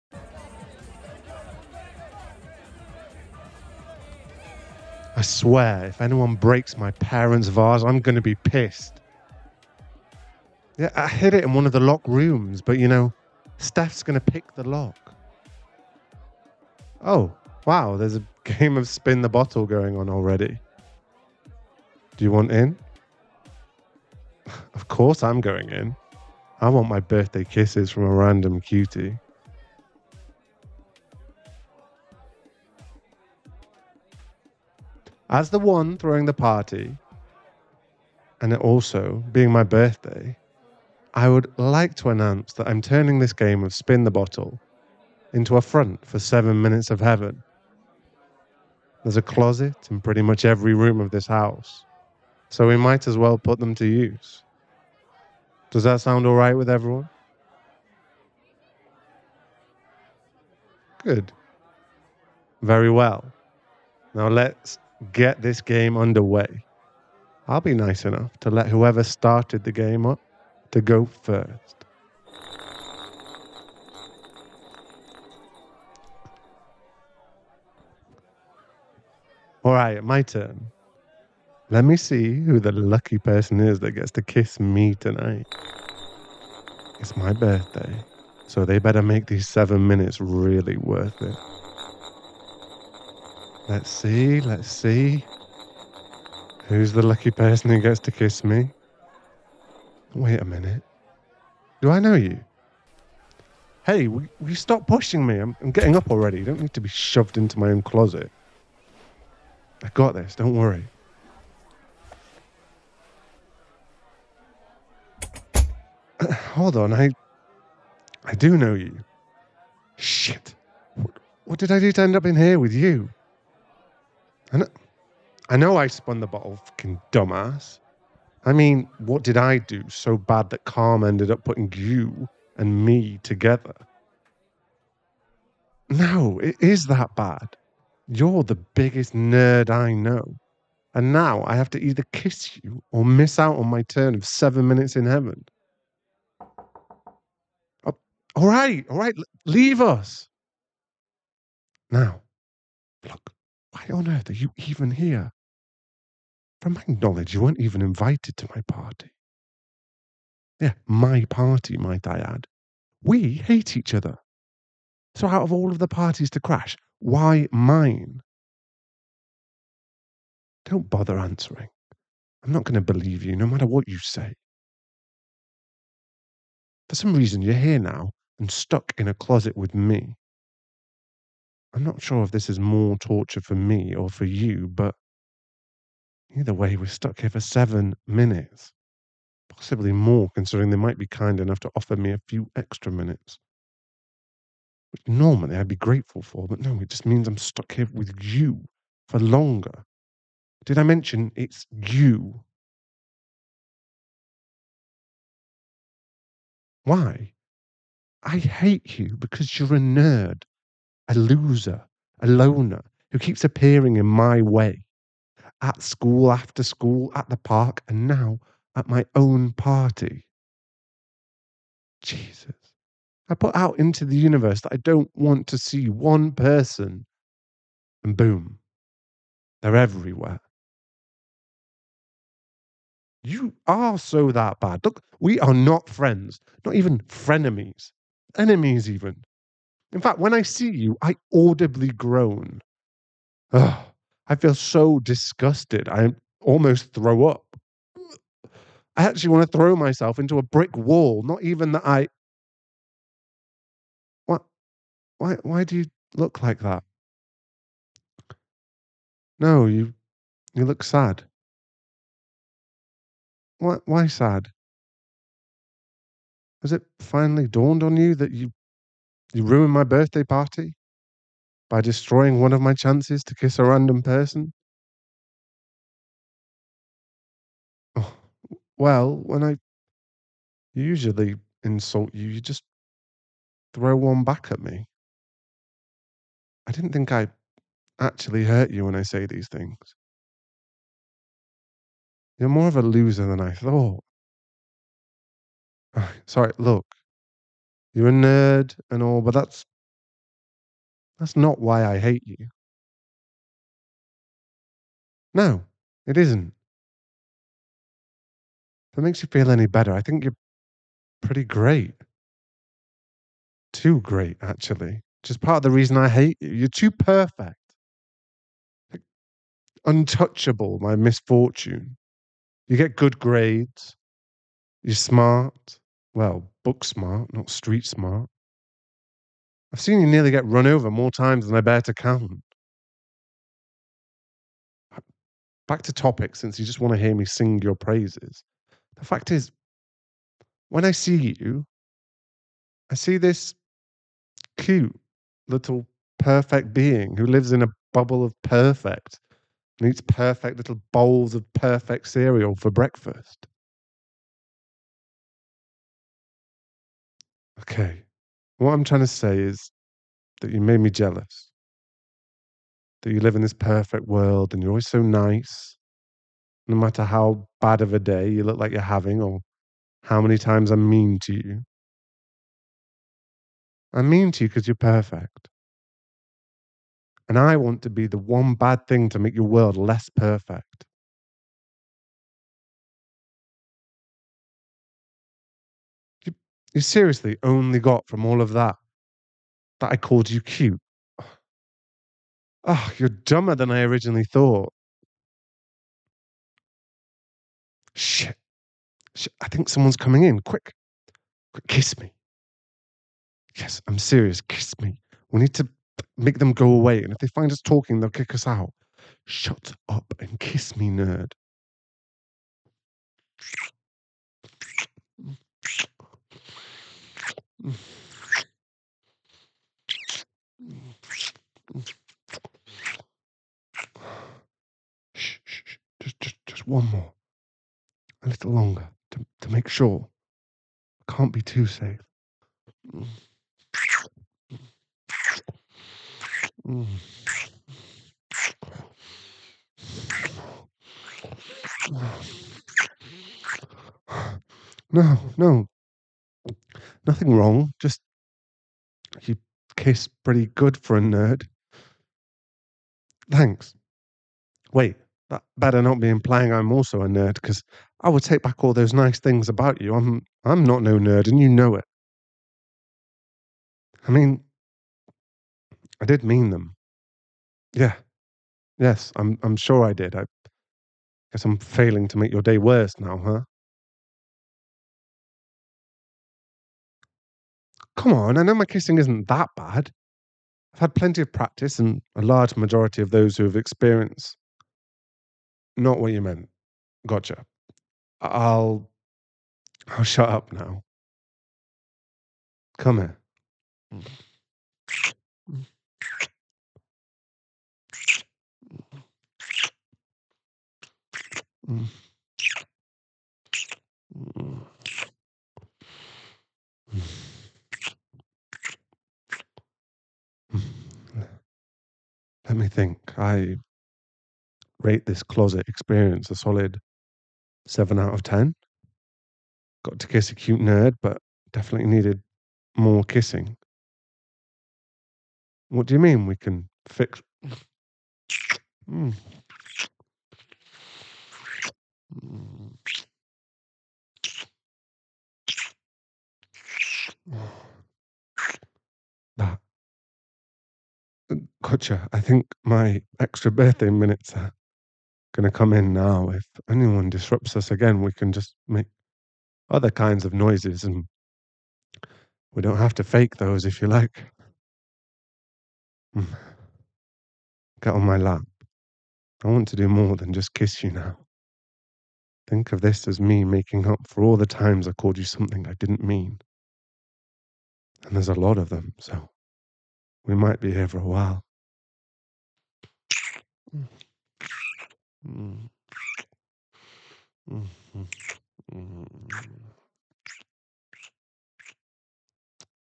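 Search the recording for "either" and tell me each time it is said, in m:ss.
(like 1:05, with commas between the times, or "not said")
2:21, 3:06.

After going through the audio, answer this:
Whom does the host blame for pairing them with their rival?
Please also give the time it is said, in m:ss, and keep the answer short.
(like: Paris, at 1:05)
Calm, at 2:10.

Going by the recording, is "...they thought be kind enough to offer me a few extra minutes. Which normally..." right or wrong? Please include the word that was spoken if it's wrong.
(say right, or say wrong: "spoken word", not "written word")
wrong: "might", not "thought".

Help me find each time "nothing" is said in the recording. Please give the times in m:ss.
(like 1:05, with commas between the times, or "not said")
7:27.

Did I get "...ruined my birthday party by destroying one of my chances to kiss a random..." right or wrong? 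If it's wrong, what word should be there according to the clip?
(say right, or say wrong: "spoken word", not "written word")
right.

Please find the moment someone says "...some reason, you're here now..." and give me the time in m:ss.
2:56.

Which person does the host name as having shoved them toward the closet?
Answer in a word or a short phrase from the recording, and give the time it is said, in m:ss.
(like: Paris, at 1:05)
Will, at 1:44.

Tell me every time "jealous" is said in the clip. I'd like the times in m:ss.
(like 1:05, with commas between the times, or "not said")
6:00.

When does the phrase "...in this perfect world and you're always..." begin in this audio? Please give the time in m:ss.
6:03.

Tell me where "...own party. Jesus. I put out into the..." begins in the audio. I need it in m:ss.
3:39.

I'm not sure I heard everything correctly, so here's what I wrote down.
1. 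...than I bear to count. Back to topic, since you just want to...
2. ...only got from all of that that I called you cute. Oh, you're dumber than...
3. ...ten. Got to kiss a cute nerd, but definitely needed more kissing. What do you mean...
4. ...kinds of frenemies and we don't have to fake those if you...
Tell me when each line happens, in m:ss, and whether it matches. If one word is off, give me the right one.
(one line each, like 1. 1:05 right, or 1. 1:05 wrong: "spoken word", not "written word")
1. 5:31 right
2. 6:27 right
3. 8:38 right
4. 9:09 wrong: "noises", not "frenemies".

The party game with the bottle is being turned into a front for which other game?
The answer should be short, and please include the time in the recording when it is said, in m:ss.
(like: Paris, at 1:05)
Seven Minutes of Heaven, at 0:46.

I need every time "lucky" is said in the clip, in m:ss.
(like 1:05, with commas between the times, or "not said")
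1:22, 1:37.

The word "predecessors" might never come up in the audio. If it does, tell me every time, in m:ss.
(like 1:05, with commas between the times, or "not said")
not said.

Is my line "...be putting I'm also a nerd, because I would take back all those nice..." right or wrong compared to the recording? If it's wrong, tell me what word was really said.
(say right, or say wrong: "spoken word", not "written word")
wrong: "implying", not "putting".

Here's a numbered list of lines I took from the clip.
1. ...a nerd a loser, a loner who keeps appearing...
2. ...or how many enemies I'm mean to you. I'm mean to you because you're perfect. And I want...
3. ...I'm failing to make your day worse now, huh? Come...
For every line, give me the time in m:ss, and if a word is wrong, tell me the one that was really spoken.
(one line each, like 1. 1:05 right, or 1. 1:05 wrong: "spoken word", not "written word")
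1. 3:29 right
2. 6:09 wrong: "times", not "enemies"
3. 7:51 right.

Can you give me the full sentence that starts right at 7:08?
A little longer to, to make sure.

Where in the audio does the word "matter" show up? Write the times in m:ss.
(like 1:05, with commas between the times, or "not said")
2:53, 6:06.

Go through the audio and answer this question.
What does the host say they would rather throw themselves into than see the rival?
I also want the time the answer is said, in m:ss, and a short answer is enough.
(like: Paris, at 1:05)
A brick wall, at 4:10.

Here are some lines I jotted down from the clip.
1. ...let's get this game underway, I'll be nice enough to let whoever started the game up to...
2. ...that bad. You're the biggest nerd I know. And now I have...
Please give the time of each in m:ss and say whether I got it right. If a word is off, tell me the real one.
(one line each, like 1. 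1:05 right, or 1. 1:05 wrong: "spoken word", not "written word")
1. 1:04 right
2. 2:16 right.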